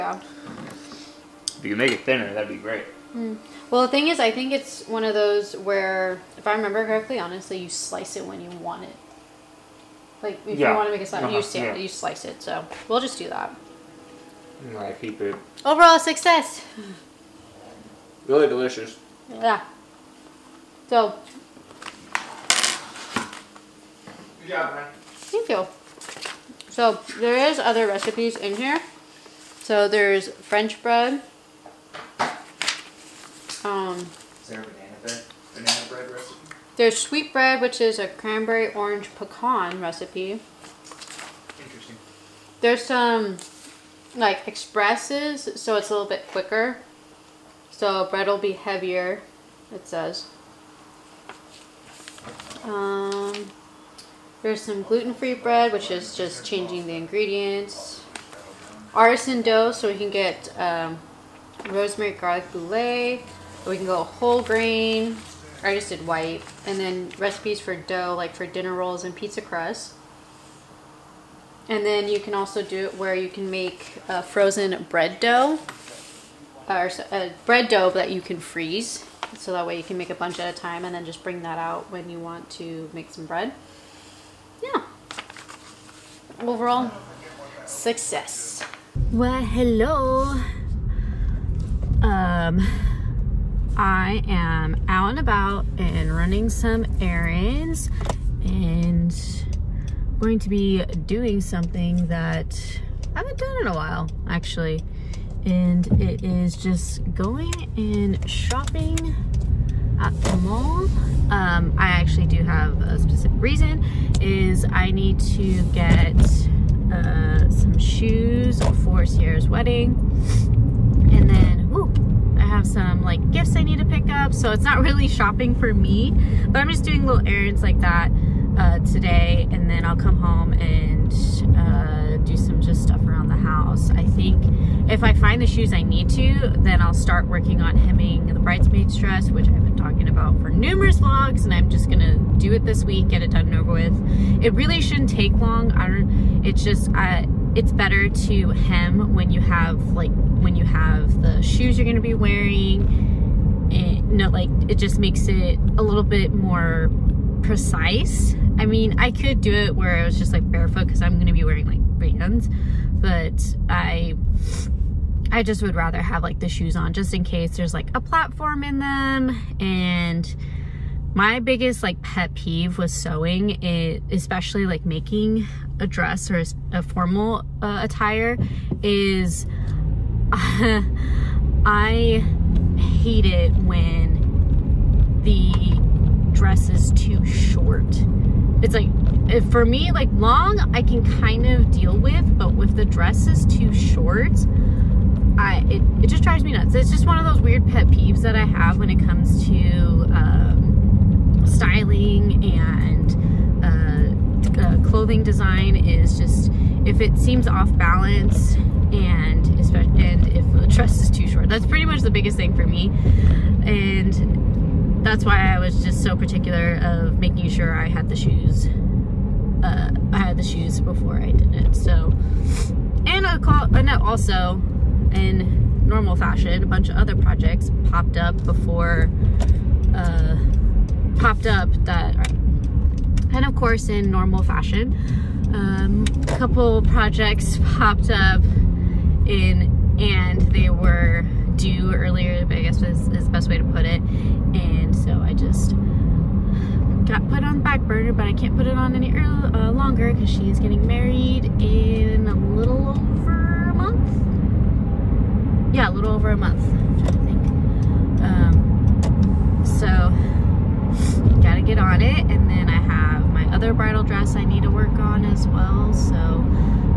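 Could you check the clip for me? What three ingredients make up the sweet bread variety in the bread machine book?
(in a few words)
Cranberry orange pecan.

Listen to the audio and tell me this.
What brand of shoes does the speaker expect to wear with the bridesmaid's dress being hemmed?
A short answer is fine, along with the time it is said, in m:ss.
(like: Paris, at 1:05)
Vans, at 2:41.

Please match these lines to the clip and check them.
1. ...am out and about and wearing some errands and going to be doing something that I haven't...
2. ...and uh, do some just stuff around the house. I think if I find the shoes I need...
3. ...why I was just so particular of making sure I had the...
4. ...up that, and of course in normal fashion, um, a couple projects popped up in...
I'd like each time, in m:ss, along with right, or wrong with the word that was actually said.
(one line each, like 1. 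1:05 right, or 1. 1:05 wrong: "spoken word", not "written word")
1. 1:34 wrong: "running", not "wearing"
2. 2:10 right
3. 3:35 right
4. 3:51 right.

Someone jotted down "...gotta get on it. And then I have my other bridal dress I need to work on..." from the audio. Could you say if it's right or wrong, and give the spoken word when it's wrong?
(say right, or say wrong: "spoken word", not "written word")
right.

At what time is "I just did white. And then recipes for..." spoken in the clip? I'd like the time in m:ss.
1:05.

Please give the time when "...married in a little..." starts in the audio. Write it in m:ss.
4:10.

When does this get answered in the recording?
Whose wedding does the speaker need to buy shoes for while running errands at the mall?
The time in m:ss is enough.
1:59.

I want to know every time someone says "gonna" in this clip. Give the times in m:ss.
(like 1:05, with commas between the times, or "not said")
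2:21, 2:31, 2:41.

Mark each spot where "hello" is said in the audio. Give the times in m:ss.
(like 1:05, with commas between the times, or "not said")
1:29.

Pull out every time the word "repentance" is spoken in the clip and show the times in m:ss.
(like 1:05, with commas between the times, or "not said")
not said.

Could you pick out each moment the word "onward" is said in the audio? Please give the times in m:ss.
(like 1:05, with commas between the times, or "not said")
not said.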